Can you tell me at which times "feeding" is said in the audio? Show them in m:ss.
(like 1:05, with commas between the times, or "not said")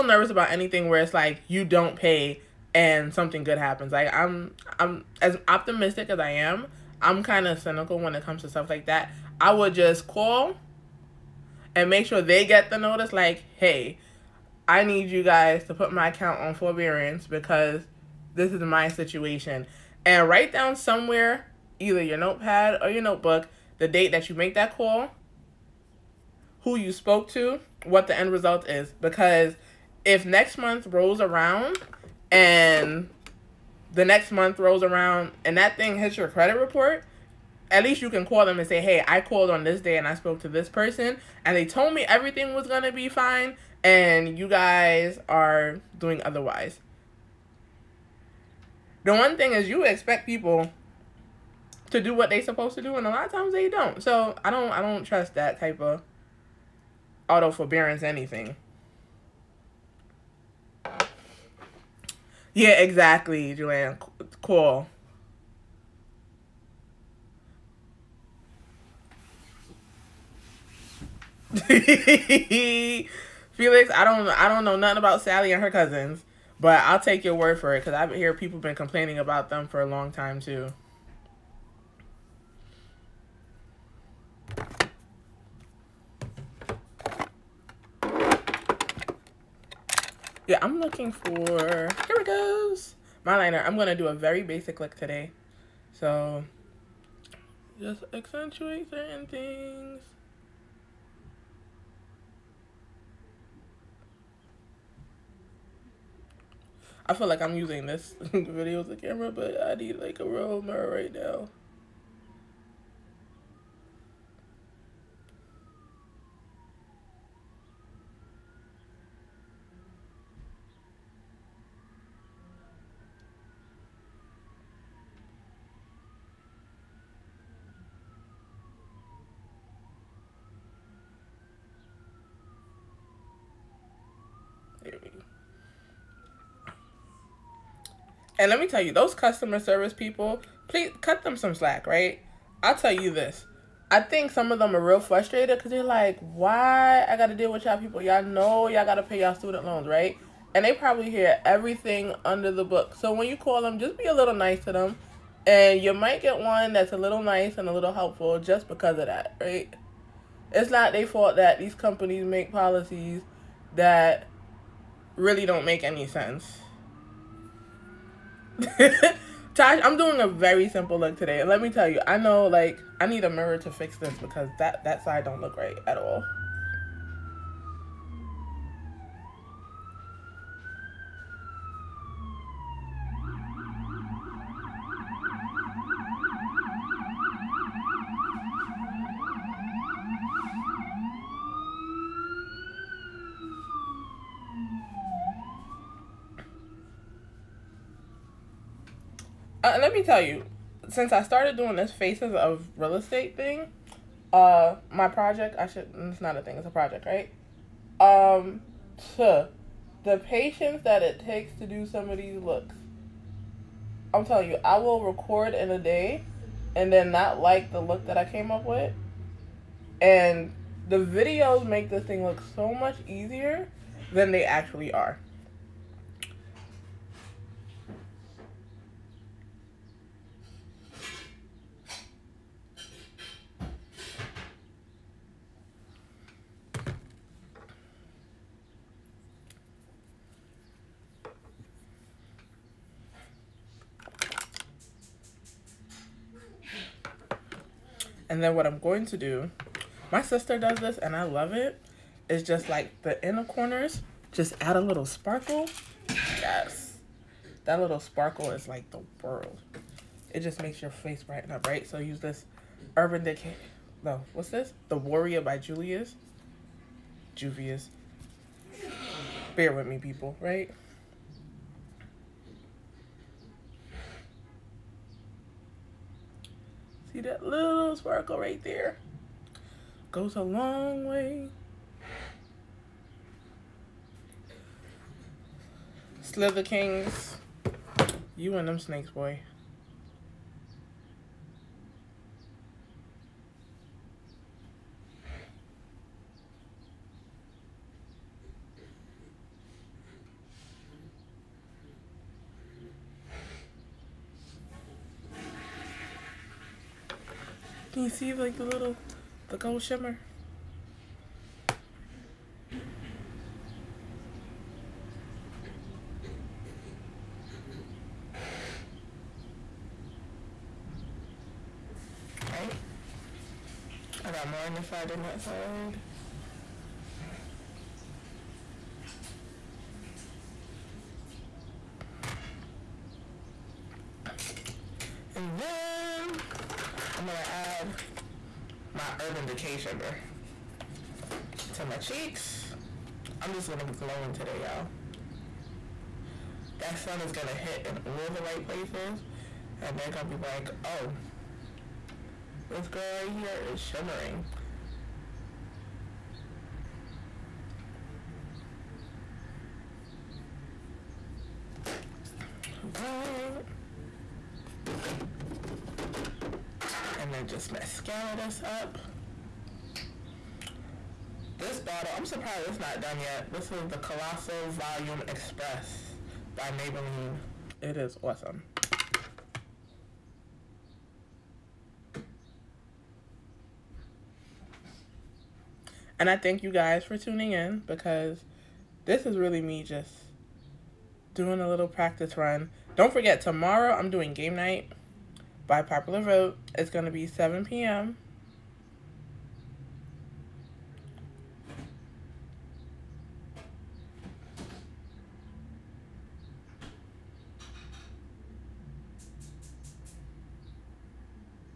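not said.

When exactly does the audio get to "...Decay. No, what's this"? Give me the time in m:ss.
4:23.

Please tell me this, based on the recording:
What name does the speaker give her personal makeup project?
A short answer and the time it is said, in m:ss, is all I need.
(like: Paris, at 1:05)
faces of real estate, at 3:21.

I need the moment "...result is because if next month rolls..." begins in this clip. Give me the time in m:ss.
0:28.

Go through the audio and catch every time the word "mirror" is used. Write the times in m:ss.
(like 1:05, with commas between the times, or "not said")
1:50, 2:53.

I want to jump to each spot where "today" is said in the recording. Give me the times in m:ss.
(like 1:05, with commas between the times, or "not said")
1:34, 2:51, 5:44.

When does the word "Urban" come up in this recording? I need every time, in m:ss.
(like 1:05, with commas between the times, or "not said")
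4:22, 5:39.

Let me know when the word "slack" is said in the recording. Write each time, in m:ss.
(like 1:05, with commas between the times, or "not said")
2:21.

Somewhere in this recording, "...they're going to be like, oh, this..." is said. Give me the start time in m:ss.
5:49.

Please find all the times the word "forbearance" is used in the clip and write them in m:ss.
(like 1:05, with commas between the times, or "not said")
0:16, 0:57.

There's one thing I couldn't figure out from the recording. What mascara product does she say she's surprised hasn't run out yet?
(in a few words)
Colossal Volume Express.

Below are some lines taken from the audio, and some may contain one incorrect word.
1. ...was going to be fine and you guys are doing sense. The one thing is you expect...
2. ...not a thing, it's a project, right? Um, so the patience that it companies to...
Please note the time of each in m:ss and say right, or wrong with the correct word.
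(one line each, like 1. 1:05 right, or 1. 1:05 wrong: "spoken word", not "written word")
1. 0:42 wrong: "otherwise", not "sense"
2. 3:26 wrong: "takes", not "companies".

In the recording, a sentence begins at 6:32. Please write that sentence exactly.
Don't forget, tomorrow I'm doing game night by popular vote.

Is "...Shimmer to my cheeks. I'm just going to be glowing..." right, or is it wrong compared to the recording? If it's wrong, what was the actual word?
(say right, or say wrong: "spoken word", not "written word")
right.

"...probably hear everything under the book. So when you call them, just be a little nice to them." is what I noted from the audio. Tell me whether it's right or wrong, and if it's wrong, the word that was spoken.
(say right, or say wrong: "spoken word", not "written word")
right.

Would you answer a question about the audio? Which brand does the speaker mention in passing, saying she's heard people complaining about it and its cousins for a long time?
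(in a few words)
Sally.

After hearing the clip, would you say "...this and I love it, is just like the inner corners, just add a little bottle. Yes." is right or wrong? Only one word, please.
wrong.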